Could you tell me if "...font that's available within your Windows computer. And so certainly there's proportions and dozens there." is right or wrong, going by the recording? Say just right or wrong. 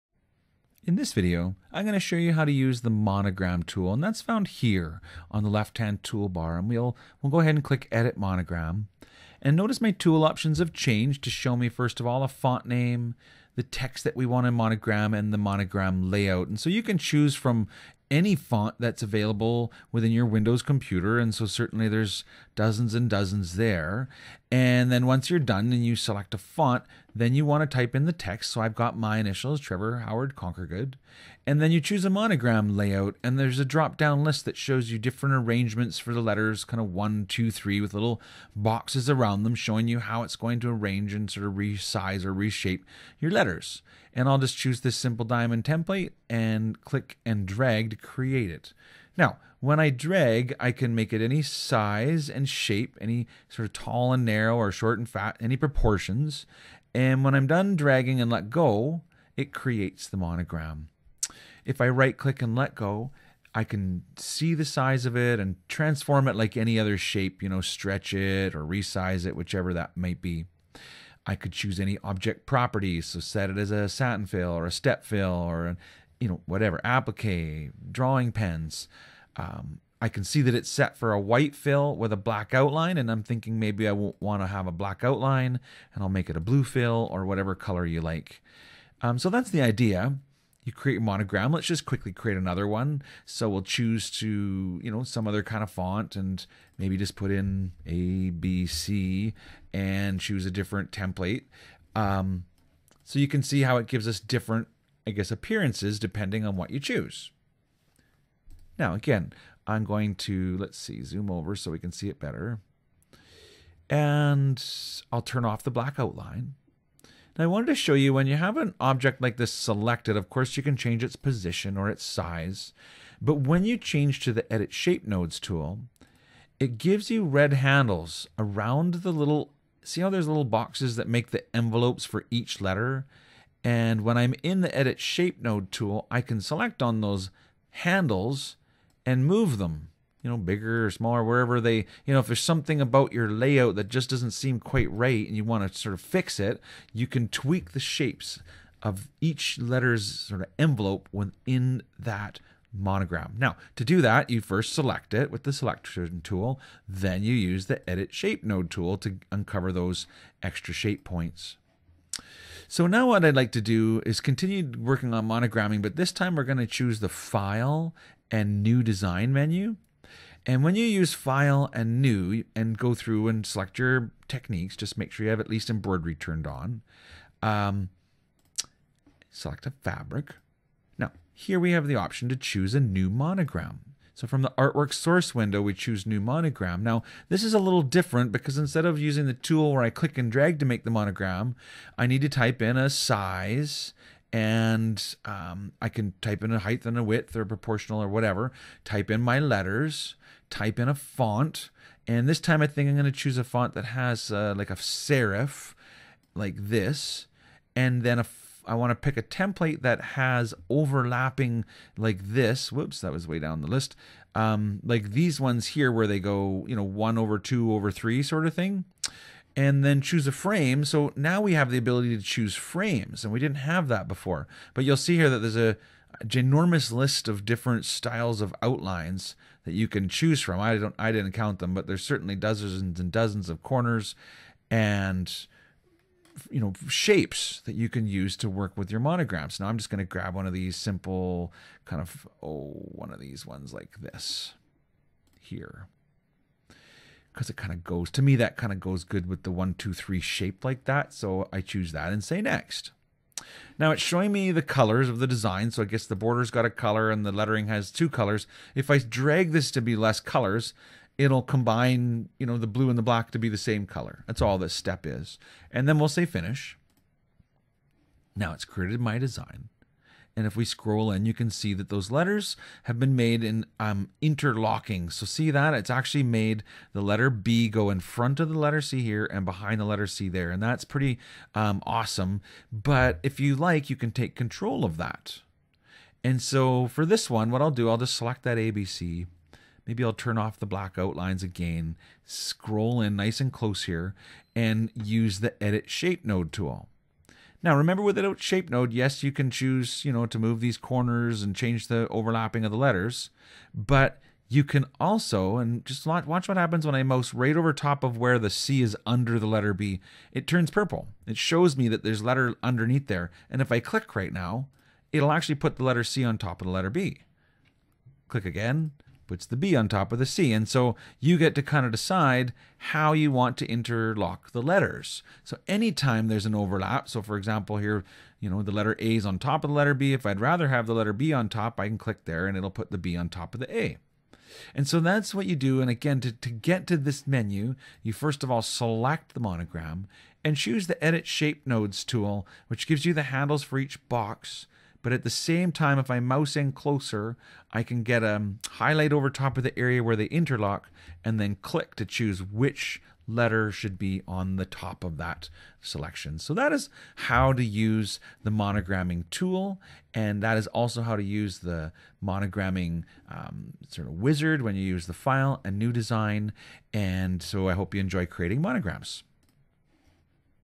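wrong.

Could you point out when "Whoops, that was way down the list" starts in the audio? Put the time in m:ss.
3:32.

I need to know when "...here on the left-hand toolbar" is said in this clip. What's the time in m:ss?
0:04.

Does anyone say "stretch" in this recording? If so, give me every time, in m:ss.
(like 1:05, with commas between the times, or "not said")
1:07.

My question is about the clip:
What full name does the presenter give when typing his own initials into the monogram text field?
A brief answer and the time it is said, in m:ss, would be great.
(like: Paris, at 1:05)
Trevor Howard Conquergood, at 0:29.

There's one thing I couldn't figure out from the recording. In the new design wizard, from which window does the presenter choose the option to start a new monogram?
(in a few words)
artwork source window.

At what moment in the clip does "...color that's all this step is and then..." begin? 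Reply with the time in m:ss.
4:23.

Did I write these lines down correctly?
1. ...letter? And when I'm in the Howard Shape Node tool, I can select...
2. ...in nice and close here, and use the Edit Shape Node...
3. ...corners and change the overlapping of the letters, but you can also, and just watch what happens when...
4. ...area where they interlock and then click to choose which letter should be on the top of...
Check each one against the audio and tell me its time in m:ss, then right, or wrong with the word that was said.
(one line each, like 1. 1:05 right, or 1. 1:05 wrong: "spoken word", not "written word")
1. 2:12 wrong: "Edit", not "Howard"
2. 4:53 right
3. 5:00 right
4. 5:49 right.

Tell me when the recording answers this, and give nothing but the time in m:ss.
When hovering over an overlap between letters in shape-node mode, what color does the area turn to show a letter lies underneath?
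5:10.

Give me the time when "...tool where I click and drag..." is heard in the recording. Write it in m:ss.
3:09.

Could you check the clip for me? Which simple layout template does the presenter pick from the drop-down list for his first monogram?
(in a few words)
diamond.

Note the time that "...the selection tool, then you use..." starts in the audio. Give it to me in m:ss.
2:35.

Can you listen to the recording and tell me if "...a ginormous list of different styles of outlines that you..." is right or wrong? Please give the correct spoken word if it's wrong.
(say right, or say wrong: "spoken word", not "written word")
right.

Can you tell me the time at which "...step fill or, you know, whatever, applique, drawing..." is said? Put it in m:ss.
1:14.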